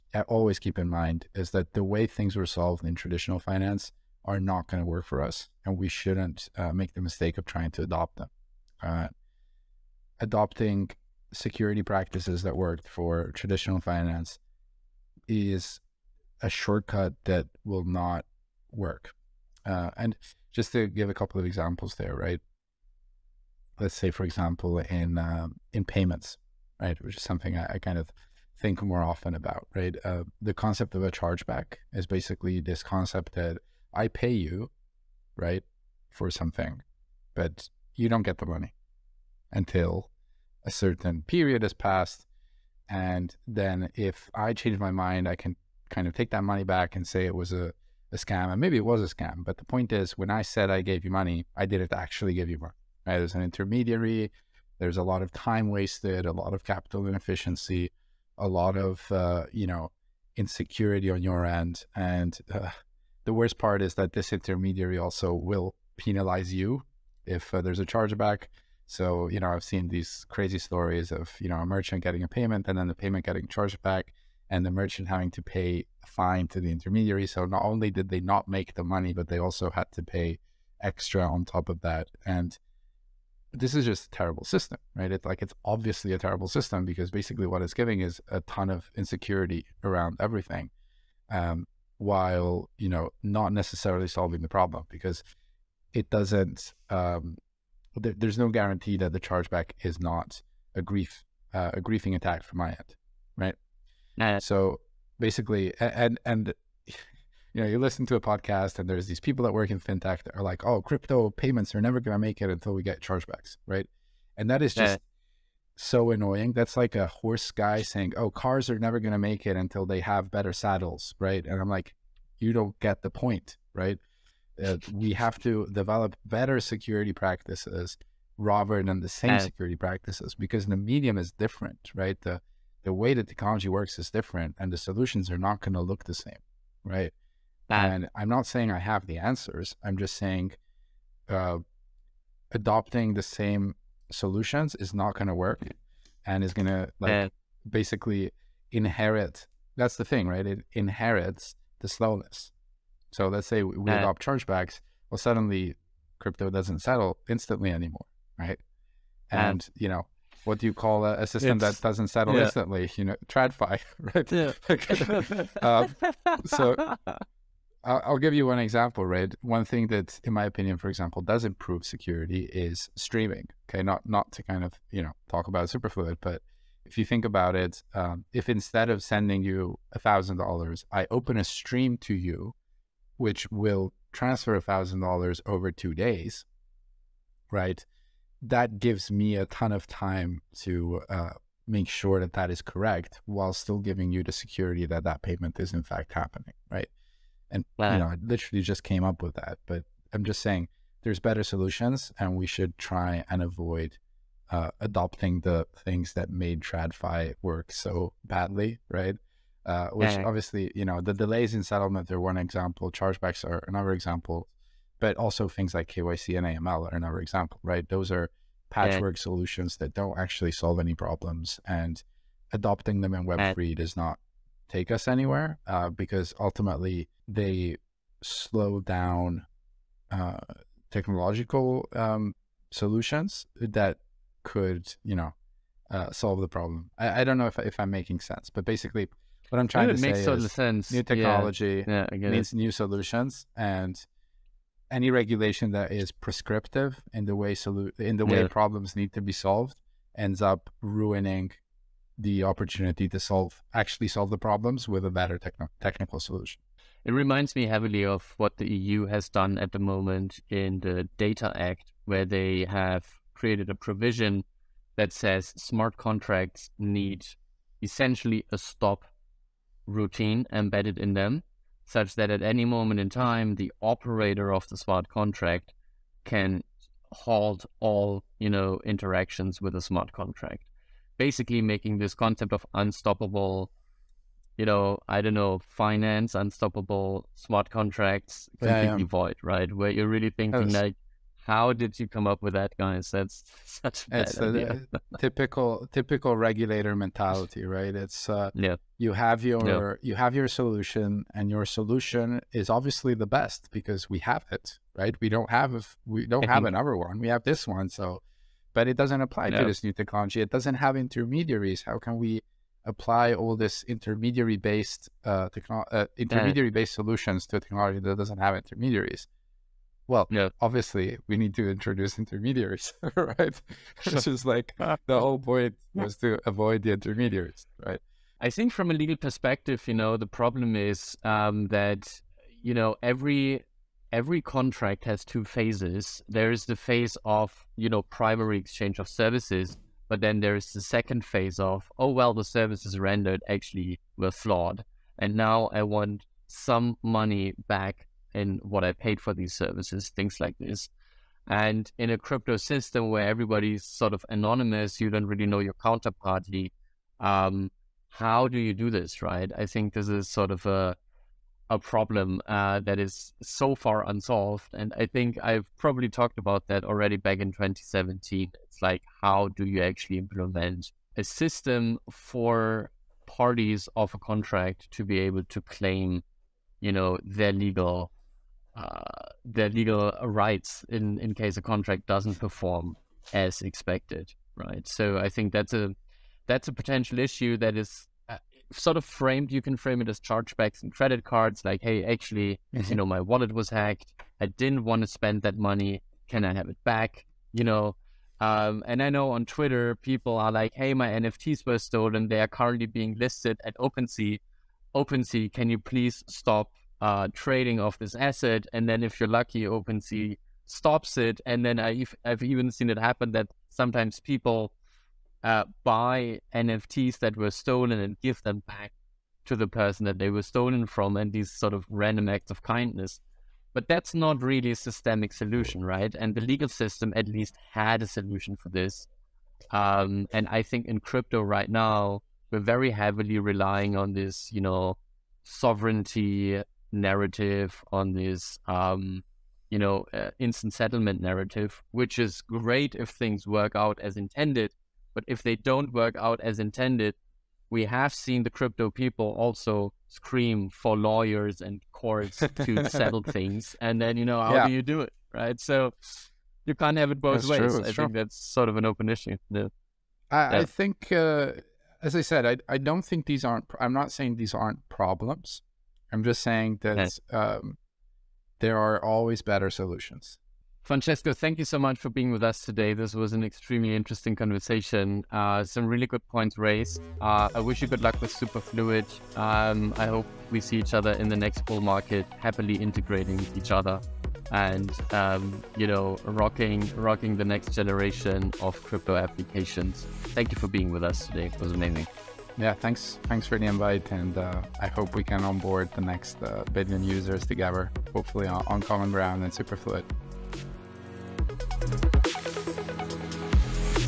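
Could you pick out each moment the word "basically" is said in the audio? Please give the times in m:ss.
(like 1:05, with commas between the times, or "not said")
0:32, 1:27, 1:45, 2:27, 3:58, 4:41.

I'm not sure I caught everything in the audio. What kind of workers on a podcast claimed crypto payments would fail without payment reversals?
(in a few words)
Fintech.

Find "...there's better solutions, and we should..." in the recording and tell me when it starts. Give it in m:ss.
3:21.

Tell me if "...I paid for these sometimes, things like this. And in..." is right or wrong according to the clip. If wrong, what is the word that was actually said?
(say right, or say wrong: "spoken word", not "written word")
wrong: "services", not "sometimes".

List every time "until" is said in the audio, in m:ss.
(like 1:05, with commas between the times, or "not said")
0:39, 1:52, 1:59.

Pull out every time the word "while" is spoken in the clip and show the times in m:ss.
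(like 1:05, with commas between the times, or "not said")
1:31, 3:13.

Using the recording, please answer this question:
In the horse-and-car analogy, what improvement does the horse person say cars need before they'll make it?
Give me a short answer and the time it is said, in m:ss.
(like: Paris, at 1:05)
Better saddles, at 2:00.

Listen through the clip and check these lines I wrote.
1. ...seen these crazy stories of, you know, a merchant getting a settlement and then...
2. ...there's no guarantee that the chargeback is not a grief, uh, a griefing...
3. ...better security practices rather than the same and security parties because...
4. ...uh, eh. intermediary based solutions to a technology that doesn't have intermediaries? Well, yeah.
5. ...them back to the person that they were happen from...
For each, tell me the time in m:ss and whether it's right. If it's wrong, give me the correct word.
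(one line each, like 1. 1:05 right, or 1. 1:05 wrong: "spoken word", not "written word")
1. 1:09 wrong: "payment", not "settlement"
2. 1:38 right
3. 2:06 wrong: "practices", not "parties"
4. 5:15 right
5. 6:58 wrong: "stolen", not "happen".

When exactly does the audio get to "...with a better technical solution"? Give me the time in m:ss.
4:14.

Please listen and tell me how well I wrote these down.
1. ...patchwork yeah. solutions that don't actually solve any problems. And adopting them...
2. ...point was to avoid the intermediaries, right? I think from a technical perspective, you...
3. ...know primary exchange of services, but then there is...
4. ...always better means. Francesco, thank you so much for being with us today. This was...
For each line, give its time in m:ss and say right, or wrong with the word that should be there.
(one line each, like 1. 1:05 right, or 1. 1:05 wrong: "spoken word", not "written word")
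1. 3:38 right
2. 5:25 wrong: "legal", not "technical"
3. 5:37 right
4. 7:49 wrong: "solutions", not "means".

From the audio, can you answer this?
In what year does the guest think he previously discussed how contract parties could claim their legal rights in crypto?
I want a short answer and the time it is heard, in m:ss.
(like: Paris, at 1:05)
2017, at 6:07.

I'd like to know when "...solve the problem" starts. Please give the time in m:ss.
3:56.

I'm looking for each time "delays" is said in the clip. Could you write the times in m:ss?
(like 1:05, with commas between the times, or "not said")
3:31.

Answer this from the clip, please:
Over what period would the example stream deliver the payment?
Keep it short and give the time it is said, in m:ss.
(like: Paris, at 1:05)
Two days, at 3:05.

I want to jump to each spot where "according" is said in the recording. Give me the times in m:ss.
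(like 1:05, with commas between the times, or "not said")
not said.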